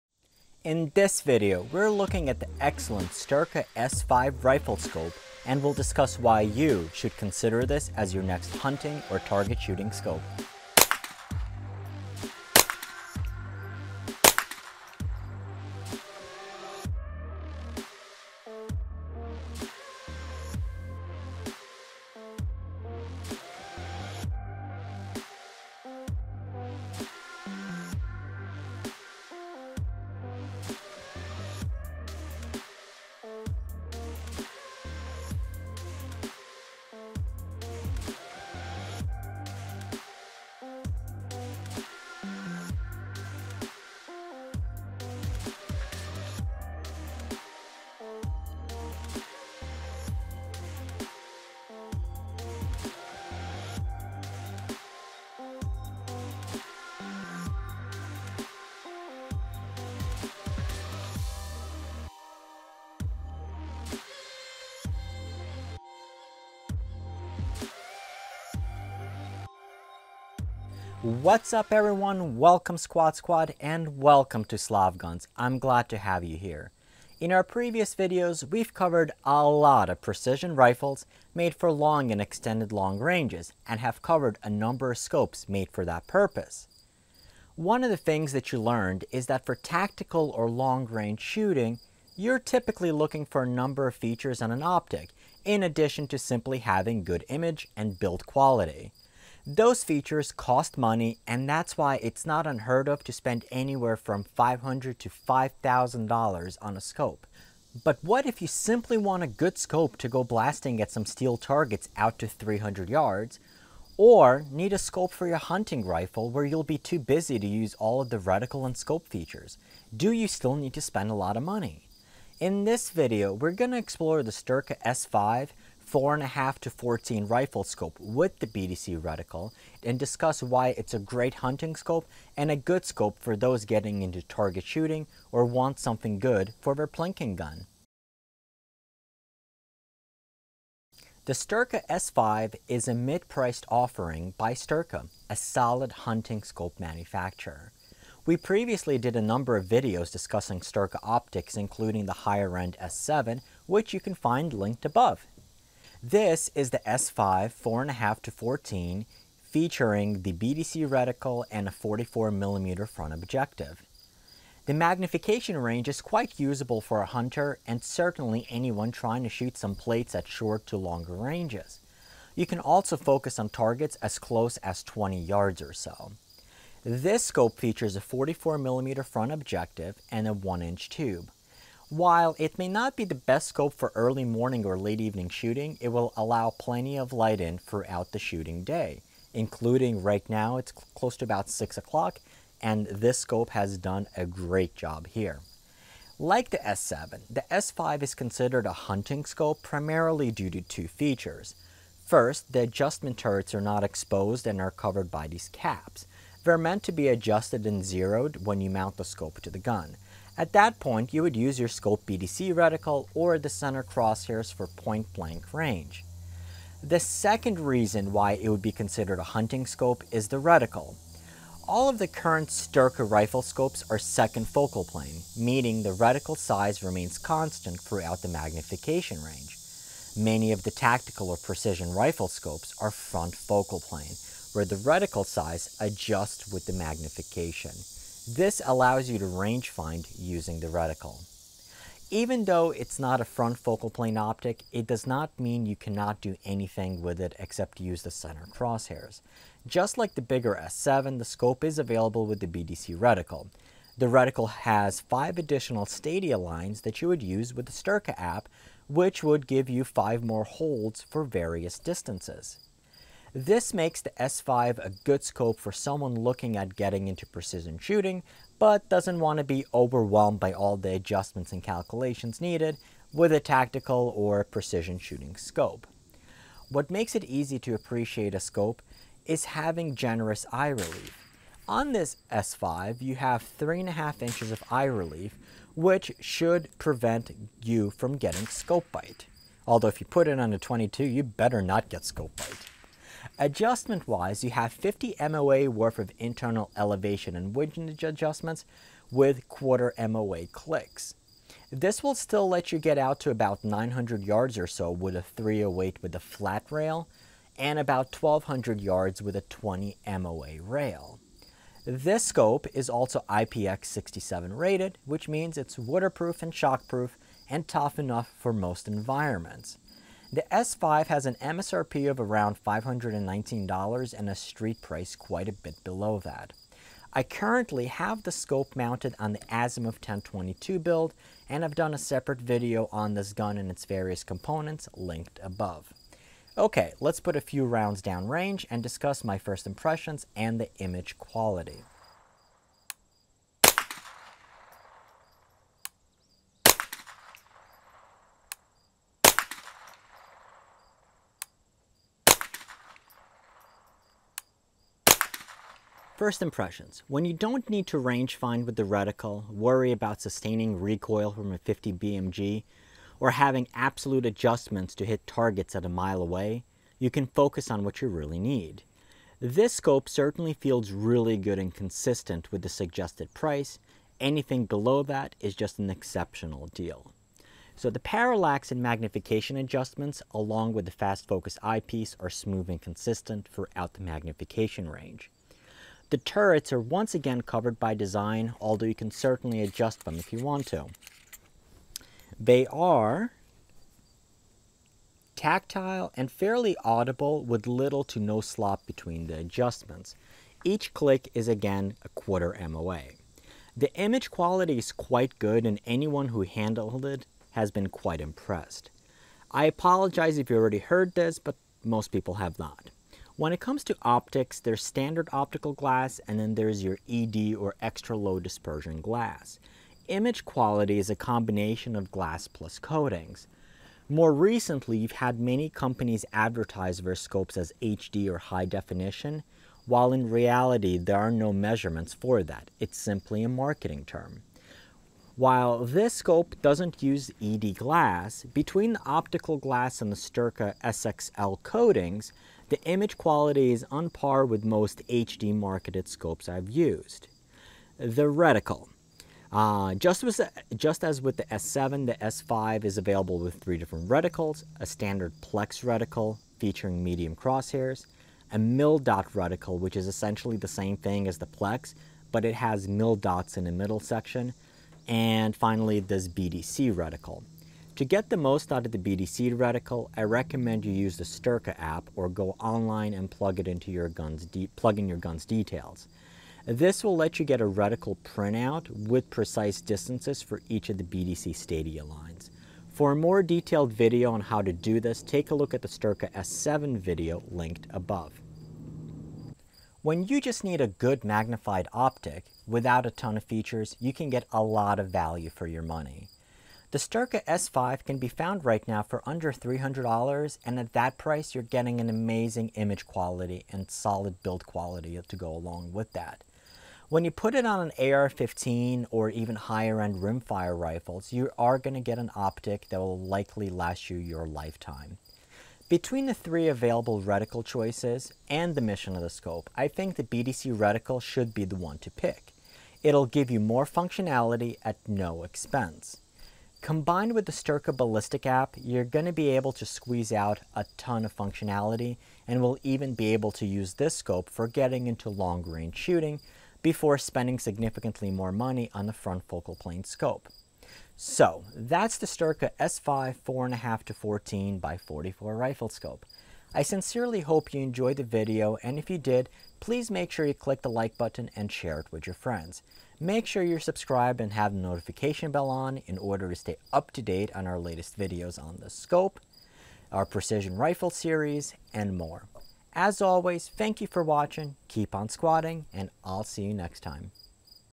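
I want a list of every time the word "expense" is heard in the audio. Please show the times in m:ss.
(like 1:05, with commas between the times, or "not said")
8:45.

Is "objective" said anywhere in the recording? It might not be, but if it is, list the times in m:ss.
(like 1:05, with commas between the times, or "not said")
2:43, 2:59.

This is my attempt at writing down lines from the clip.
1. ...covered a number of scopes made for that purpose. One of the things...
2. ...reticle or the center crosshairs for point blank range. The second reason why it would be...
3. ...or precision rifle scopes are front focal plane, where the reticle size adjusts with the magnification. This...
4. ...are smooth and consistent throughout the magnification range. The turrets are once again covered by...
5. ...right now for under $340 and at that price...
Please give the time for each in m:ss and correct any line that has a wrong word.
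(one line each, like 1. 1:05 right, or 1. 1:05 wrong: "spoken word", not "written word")
1. 1:24 right
2. 3:32 right
3. 3:51 right
4. 6:22 right
5. 8:18 wrong: "300", not "340".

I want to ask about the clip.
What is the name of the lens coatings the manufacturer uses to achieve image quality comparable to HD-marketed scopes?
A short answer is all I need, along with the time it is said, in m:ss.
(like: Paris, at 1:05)
SXL, at 7:20.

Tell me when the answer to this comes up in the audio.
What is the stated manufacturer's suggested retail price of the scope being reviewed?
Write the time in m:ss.
5:22.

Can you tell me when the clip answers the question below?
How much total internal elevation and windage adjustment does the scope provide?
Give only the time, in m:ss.
4:54.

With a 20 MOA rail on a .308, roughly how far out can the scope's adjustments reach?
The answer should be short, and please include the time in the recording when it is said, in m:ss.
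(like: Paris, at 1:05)
1200 yards, at 5:08.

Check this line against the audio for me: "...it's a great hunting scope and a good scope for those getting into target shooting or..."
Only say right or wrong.
right.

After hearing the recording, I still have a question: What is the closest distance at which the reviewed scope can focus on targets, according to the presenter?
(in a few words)
20 yards.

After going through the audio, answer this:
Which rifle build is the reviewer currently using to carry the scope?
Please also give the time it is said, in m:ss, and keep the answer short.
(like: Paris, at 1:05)
Azimuth 1022, at 5:29.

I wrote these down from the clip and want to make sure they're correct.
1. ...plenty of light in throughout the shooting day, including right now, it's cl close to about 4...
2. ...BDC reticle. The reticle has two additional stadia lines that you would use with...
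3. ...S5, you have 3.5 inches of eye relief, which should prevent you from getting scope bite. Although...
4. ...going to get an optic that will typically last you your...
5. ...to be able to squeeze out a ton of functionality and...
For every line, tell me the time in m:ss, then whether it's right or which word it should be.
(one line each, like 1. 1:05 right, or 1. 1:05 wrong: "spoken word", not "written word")
1. 3:06 wrong: "6", not "4"
2. 4:12 wrong: "five", not "two"
3. 4:42 right
4. 8:31 wrong: "likely", not "typically"
5. 8:49 right.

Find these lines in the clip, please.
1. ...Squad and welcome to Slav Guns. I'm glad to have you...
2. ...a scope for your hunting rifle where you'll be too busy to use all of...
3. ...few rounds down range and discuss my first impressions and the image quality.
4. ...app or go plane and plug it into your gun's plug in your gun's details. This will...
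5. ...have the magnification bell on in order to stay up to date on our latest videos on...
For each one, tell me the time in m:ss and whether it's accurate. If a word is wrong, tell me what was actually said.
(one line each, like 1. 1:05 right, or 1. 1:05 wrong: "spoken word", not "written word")
1. 1:13 right
2. 1:54 right
3. 5:37 right
4. 7:51 wrong: "online", not "plane"
5. 9:14 wrong: "notification", not "magnification".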